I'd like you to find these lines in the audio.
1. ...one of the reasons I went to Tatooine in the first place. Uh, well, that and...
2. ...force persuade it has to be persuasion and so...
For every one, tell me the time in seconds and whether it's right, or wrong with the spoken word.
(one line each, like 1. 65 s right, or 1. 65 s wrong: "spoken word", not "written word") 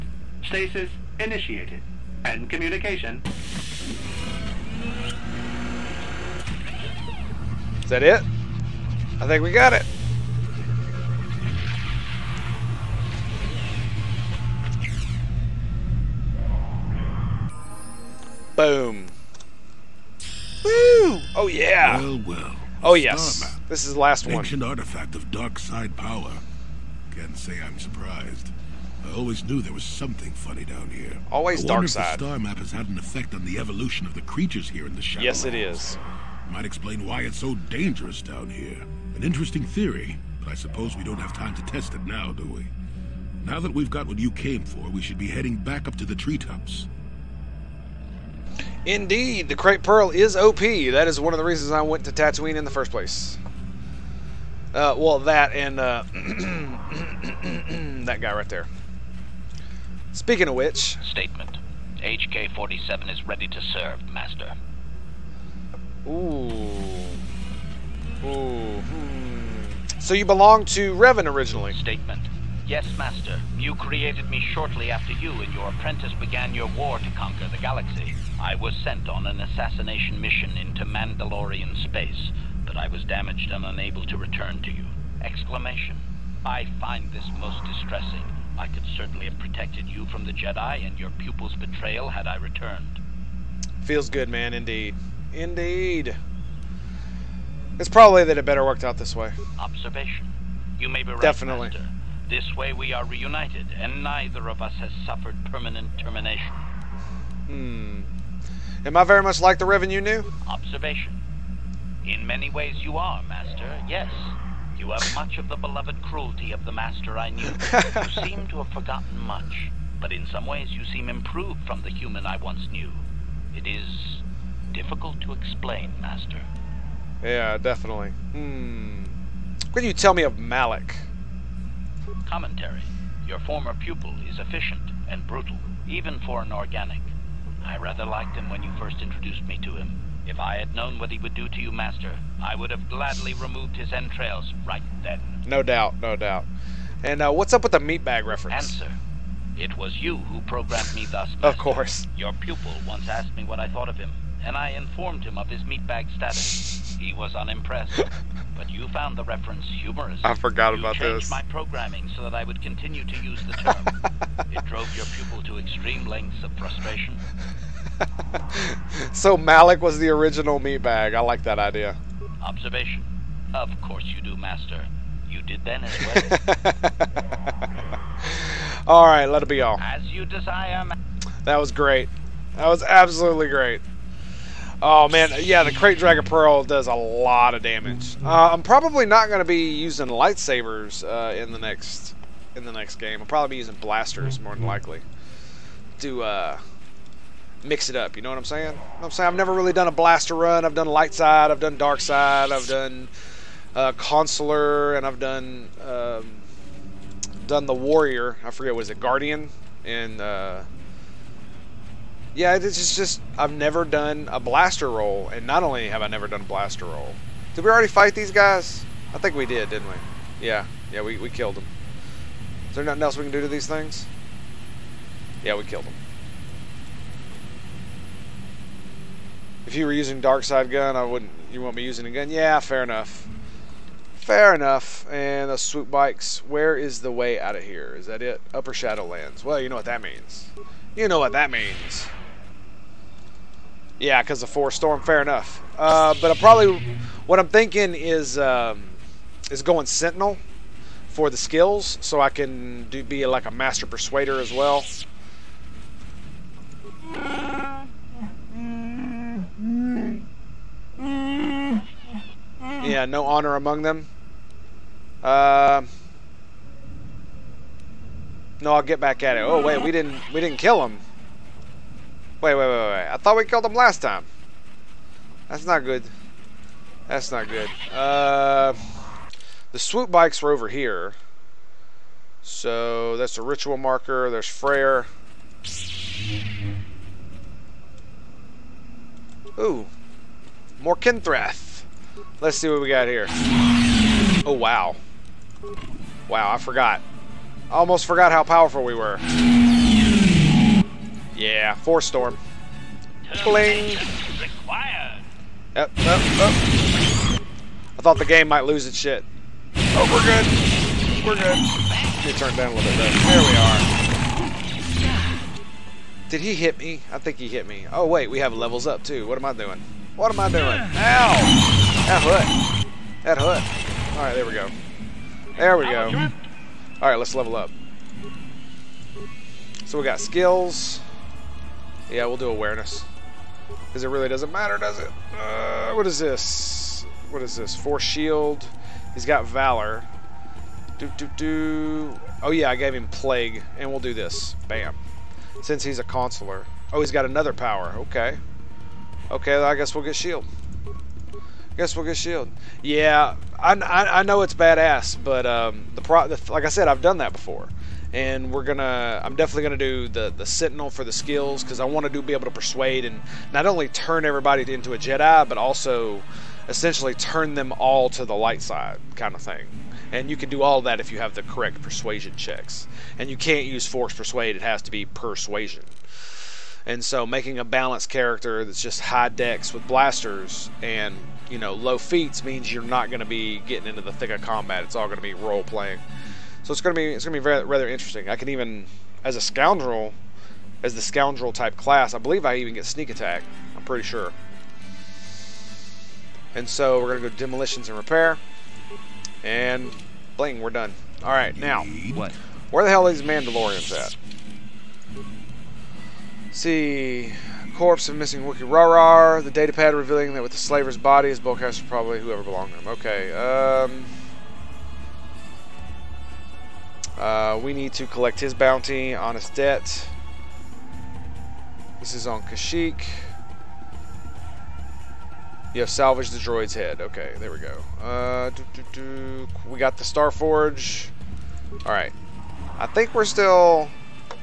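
1. 51 s right
2. 373 s right.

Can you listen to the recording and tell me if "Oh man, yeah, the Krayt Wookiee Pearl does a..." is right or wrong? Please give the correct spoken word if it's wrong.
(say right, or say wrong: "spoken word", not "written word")
wrong: "Dragon", not "Wookiee".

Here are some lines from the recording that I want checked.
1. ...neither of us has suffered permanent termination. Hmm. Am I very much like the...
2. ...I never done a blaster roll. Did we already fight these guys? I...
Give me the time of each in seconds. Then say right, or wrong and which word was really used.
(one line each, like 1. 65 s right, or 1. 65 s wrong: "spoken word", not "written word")
1. 104 s right
2. 216 s right.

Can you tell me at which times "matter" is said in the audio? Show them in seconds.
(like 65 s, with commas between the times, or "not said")
334 s.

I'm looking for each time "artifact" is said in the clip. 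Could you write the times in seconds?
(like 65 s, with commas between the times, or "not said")
24 s.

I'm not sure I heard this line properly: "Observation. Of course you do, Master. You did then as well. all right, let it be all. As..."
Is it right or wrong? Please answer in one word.
right.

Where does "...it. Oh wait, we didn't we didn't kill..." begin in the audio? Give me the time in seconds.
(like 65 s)
269 s.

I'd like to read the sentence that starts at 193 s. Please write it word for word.
I'll probably be using blasters more than mm-hmm.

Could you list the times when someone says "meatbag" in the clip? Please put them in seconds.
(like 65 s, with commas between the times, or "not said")
147 s, 155 s, 170 s.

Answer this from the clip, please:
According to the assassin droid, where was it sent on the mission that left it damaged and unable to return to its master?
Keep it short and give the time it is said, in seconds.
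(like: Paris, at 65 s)
Mandalorian space, at 80 s.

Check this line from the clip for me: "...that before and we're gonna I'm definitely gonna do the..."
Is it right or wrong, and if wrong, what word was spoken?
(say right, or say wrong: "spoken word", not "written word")
right.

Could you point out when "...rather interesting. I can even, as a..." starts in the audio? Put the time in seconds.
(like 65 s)
387 s.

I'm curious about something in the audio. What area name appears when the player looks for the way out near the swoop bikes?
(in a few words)
Upper Shadowlands.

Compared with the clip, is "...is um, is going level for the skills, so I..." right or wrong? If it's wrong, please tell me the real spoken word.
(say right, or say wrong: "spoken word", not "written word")
wrong: "sentinel", not "level".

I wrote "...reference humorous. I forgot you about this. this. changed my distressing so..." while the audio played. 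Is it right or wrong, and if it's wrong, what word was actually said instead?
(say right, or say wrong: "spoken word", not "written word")
wrong: "programming", not "distressing".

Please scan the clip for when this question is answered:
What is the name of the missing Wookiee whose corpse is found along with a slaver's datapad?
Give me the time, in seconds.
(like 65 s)
408 s.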